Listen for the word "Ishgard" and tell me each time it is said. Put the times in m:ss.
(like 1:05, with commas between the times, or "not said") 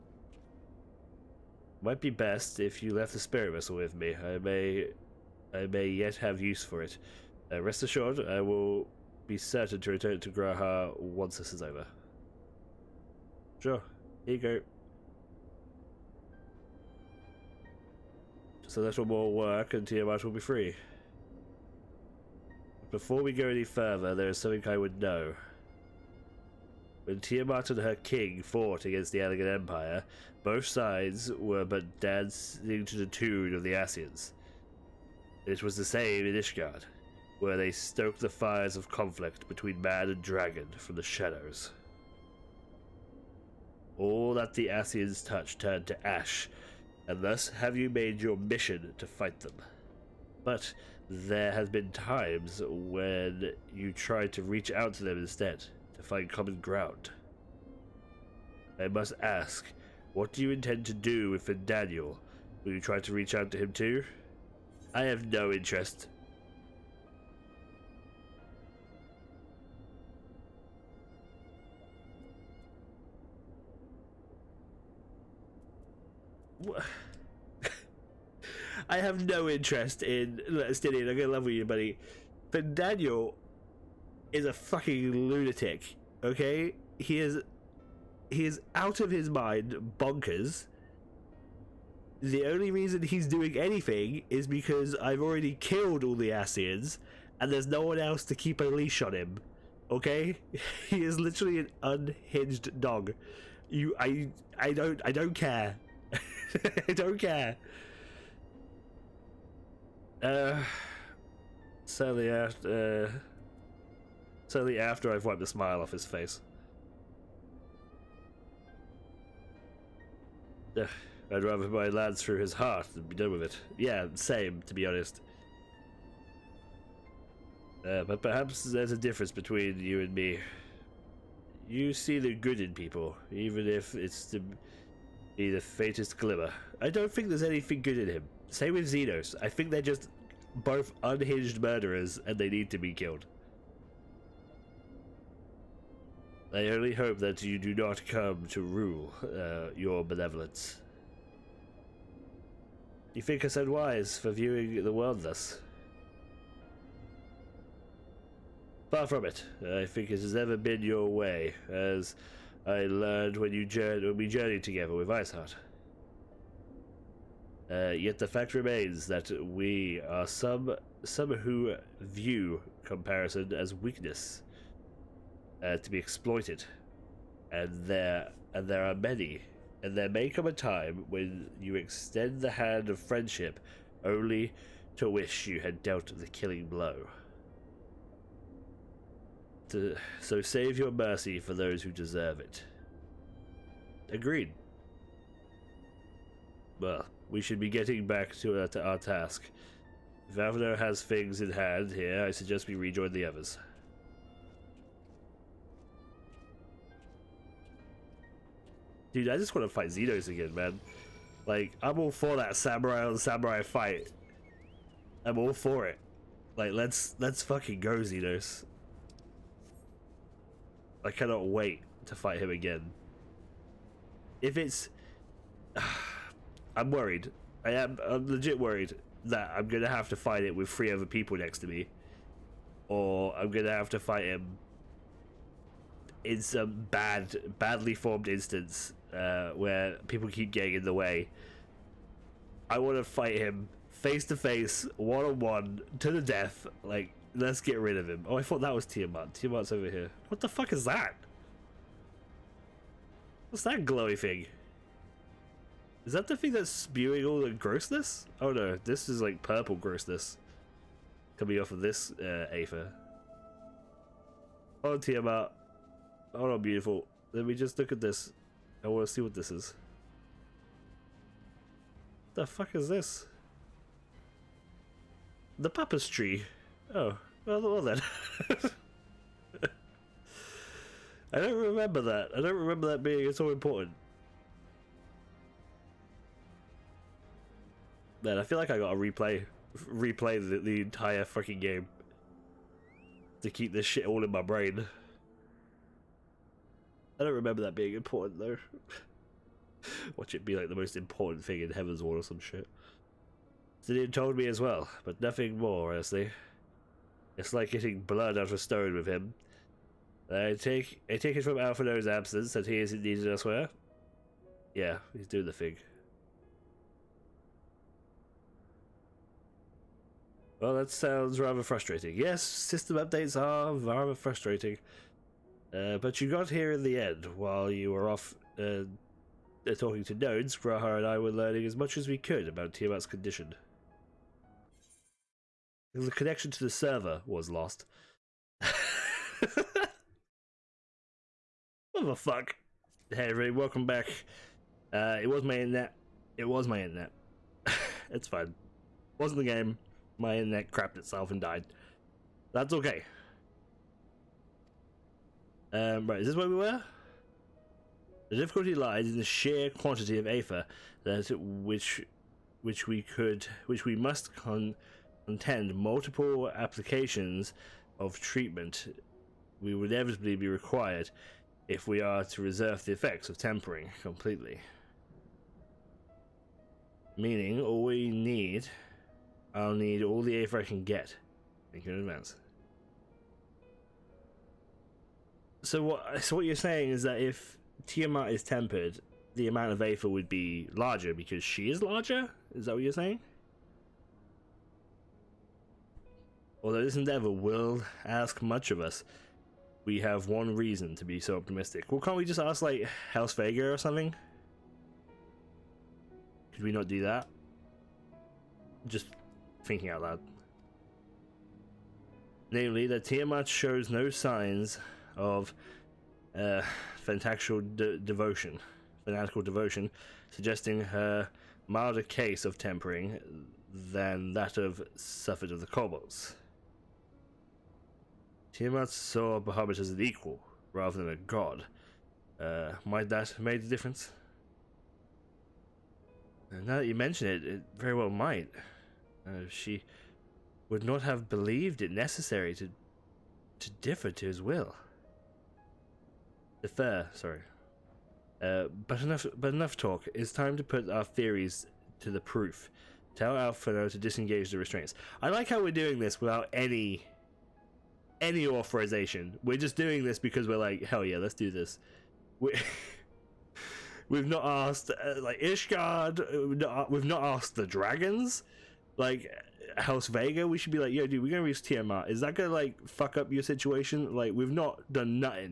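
0:36, 7:45.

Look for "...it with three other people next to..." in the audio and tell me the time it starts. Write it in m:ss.
3:50.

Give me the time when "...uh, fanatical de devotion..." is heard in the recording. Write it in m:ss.
6:56.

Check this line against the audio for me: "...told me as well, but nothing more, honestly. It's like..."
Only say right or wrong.
right.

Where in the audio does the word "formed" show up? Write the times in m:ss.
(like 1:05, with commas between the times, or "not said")
3:57.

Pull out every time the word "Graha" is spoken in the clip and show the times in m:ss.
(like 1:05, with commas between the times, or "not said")
0:10, 5:30.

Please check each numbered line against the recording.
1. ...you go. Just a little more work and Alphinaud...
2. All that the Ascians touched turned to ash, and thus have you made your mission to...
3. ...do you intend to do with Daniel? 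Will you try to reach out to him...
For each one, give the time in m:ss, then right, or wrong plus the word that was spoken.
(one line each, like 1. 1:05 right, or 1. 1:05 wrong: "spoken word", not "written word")
1. 0:14 wrong: "Tiamat", not "Alphinaud"
2. 0:43 right
3. 1:00 right.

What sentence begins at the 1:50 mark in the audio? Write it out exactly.
Uh, sadly yeah, uh, Certainly after I've wiped the smile off his face.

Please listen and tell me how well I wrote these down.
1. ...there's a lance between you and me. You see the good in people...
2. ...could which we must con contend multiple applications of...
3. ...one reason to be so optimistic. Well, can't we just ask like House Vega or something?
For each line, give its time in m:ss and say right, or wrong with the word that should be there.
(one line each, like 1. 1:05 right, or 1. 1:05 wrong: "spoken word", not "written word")
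1. 2:08 wrong: "difference", not "lance"
2. 6:03 right
3. 6:40 right.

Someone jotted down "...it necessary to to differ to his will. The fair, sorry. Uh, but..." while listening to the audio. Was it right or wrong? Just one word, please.
right.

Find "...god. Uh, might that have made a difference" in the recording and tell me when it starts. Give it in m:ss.
7:11.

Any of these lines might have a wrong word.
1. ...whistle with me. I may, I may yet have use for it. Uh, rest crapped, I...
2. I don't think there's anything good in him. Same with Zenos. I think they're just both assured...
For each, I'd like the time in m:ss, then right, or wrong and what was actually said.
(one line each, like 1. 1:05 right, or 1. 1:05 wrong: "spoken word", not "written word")
1. 0:03 wrong: "assured", not "crapped"
2. 2:16 wrong: "unhinged", not "assured".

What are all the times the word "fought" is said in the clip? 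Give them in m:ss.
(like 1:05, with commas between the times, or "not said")
0:28.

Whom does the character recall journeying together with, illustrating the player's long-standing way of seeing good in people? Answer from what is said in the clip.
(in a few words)
Iceheart.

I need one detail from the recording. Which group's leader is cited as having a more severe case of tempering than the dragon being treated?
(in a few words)
The Kobolds.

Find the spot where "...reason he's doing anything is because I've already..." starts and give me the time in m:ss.
1:32.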